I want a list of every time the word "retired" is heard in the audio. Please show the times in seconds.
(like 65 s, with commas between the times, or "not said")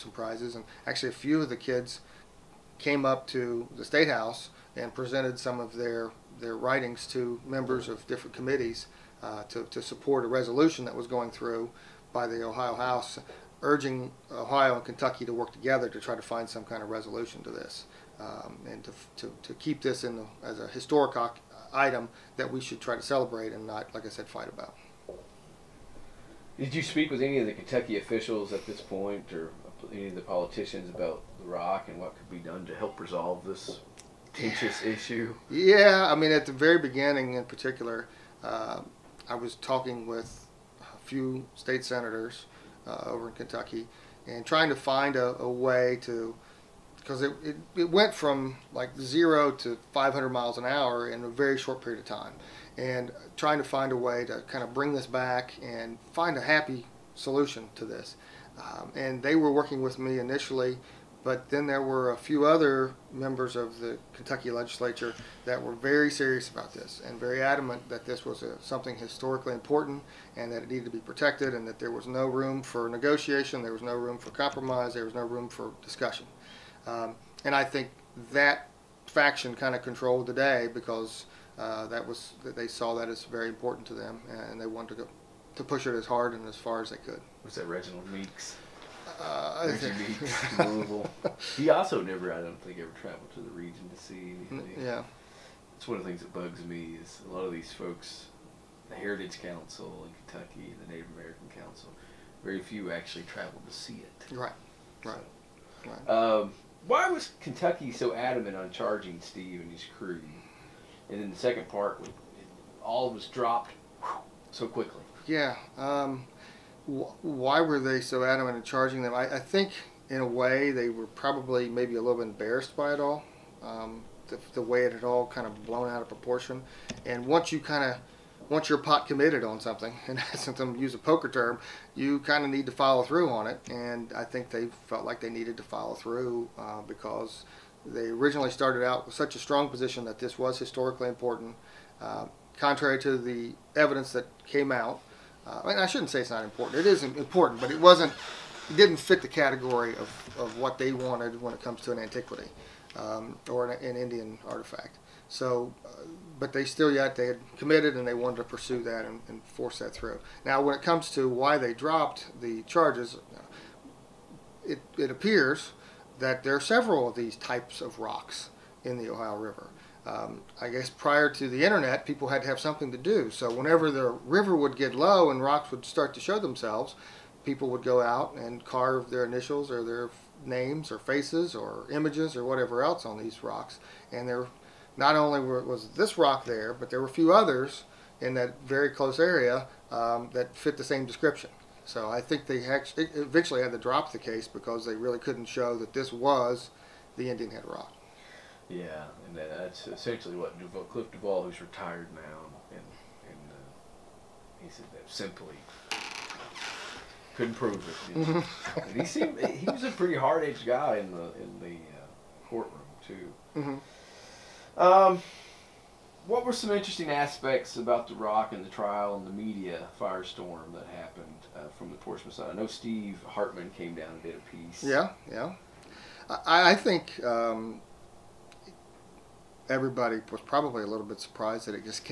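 201 s.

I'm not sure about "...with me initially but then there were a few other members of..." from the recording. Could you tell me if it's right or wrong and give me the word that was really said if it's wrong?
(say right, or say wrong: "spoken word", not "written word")
right.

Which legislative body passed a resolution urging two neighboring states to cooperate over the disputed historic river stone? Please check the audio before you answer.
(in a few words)
Ohio House.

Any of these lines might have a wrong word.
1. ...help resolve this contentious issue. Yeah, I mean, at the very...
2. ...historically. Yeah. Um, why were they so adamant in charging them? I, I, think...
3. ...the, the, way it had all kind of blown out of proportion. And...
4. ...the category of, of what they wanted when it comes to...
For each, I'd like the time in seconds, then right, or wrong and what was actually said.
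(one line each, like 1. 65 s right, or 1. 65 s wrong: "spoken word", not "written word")
1. 32 s right
2. 114 s wrong: "quickly", not "historically"
3. 124 s right
4. 149 s right.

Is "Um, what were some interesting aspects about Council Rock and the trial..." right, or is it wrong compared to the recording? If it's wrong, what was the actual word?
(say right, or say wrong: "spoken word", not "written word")
wrong: "The", not "Council".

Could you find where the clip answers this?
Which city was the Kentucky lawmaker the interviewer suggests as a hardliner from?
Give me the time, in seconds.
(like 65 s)
90 s.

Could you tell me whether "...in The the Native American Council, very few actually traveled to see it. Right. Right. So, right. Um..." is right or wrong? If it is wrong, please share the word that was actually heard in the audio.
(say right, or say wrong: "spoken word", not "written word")
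wrong: "Kentucky", not "The".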